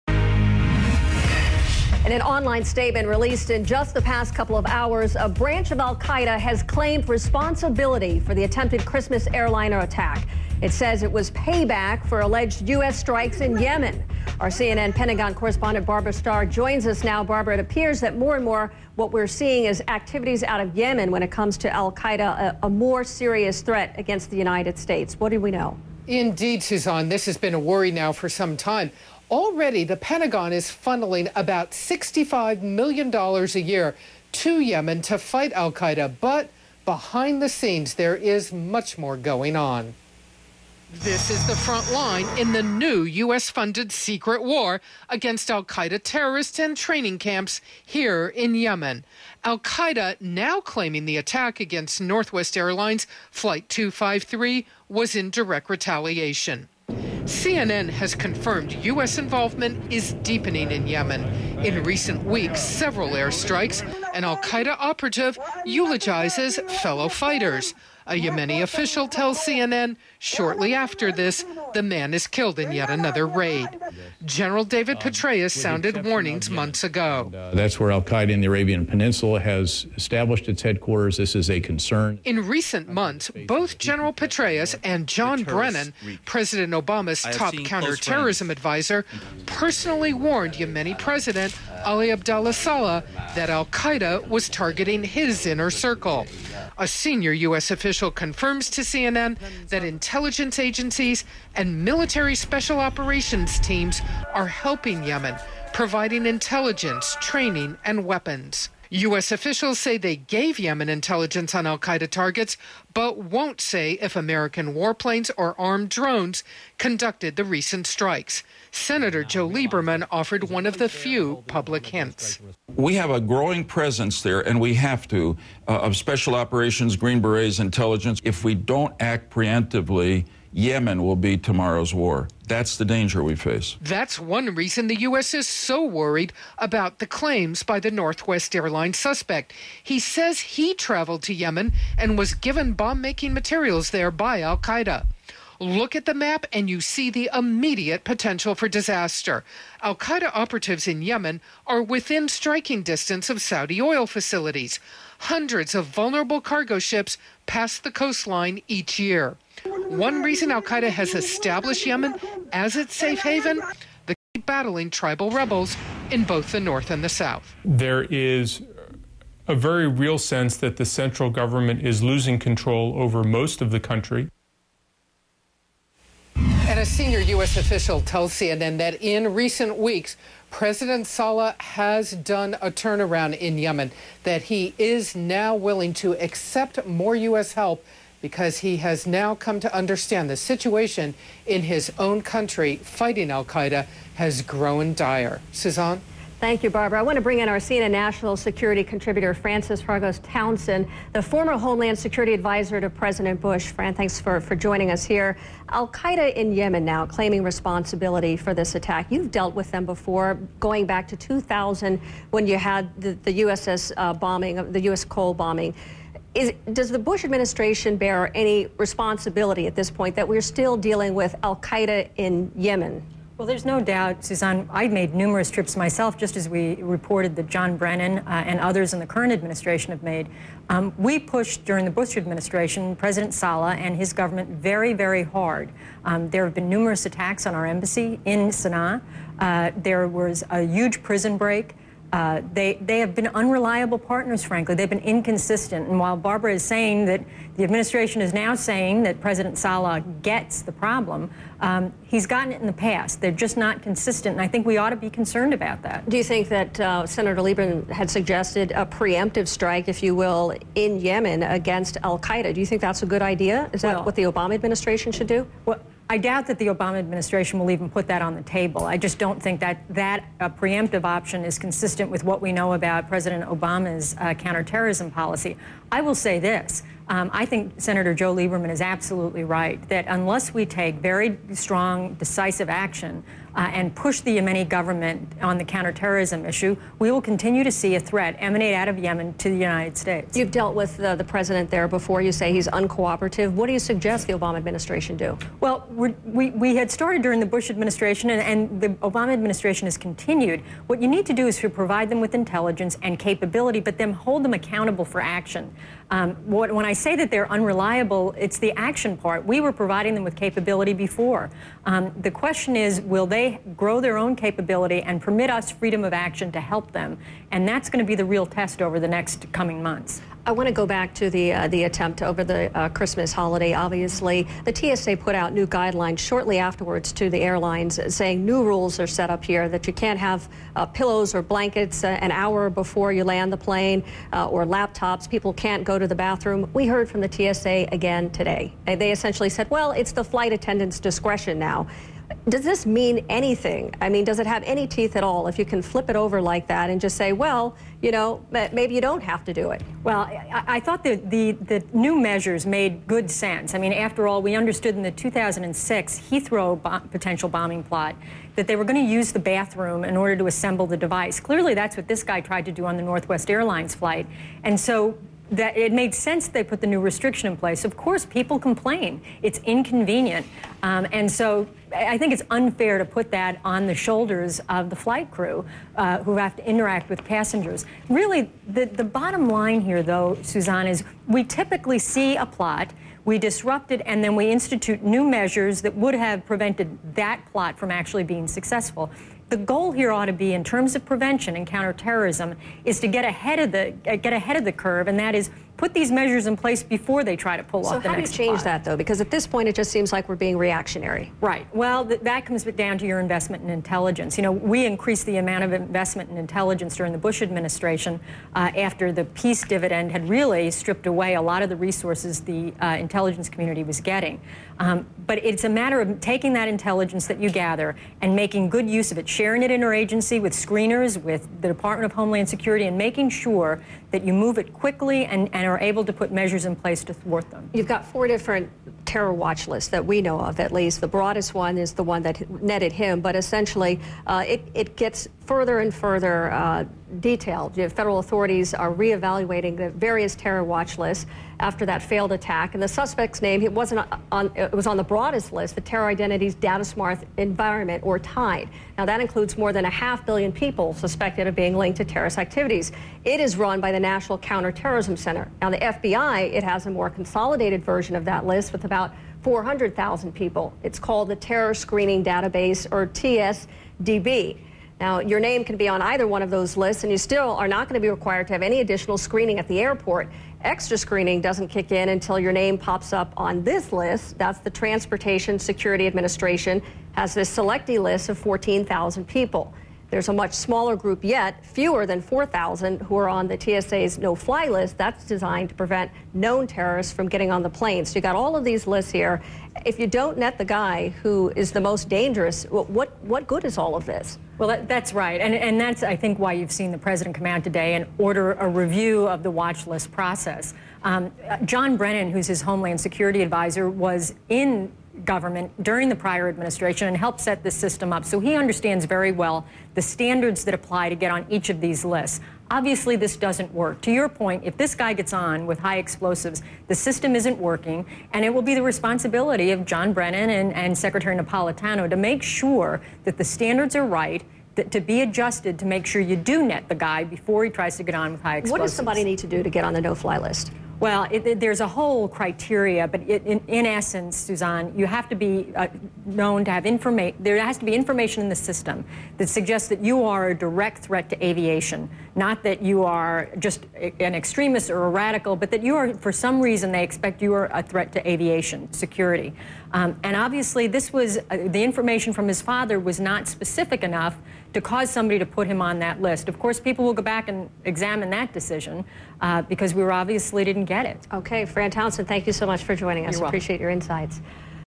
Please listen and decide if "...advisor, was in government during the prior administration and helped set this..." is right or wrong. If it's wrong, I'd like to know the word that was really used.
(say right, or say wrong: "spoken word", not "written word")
right.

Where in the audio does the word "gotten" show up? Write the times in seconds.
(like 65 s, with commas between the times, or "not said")
252 s.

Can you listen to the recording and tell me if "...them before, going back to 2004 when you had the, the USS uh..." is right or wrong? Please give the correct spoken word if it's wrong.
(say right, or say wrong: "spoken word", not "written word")
wrong: "2000", not "2004".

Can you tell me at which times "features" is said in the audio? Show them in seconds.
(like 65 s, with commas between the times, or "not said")
not said.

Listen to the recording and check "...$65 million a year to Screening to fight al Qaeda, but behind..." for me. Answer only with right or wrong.
wrong.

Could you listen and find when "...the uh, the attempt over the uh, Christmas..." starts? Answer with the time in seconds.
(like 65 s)
321 s.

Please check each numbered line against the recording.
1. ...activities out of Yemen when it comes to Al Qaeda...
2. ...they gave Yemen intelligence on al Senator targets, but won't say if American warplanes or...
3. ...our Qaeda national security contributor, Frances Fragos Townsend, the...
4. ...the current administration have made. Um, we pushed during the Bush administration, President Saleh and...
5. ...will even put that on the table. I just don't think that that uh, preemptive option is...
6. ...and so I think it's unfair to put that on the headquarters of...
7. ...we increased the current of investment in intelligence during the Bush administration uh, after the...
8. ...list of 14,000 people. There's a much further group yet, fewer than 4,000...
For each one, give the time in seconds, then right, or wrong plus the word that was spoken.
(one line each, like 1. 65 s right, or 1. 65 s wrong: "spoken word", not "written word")
1. 19 s right
2. 109 s wrong: "Qaeda", not "Senator"
3. 197 s wrong: "CNN", not "Qaeda"
4. 228 s right
5. 267 s right
6. 371 s wrong: "shoulders", not "headquarters"
7. 404 s wrong: "amount", not "current"
8. 478 s wrong: "smaller", not "further".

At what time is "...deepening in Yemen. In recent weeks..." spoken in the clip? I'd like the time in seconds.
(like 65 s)
60 s.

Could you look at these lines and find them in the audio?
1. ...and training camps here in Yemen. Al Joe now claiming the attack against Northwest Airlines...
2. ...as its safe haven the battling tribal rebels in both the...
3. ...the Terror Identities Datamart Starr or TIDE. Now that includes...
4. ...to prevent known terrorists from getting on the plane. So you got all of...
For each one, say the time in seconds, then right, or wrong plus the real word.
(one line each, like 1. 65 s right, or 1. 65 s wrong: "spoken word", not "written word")
1. 46 s wrong: "Qaeda", not "Joe"
2. 162 s right
3. 445 s wrong: "Environment", not "Starr"
4. 485 s right.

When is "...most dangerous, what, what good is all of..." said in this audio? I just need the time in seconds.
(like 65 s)
491 s.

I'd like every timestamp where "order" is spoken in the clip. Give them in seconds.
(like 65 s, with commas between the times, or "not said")
360 s, 498 s.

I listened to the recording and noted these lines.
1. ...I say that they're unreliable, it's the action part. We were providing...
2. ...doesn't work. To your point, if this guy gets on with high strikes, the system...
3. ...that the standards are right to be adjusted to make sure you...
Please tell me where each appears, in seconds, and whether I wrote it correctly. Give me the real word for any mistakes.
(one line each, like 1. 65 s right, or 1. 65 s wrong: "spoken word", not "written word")
1. 306 s right
2. 513 s wrong: "explosives", not "strikes"
3. 523 s right.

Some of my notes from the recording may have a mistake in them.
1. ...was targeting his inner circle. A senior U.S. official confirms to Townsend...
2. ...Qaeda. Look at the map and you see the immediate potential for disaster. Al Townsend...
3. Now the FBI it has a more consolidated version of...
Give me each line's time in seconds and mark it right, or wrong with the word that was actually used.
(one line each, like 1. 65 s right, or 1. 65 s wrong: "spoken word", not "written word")
1. 94 s wrong: "CNN", not "Townsend"
2. 144 s wrong: "Qaeda", not "Townsend"
3. 455 s right.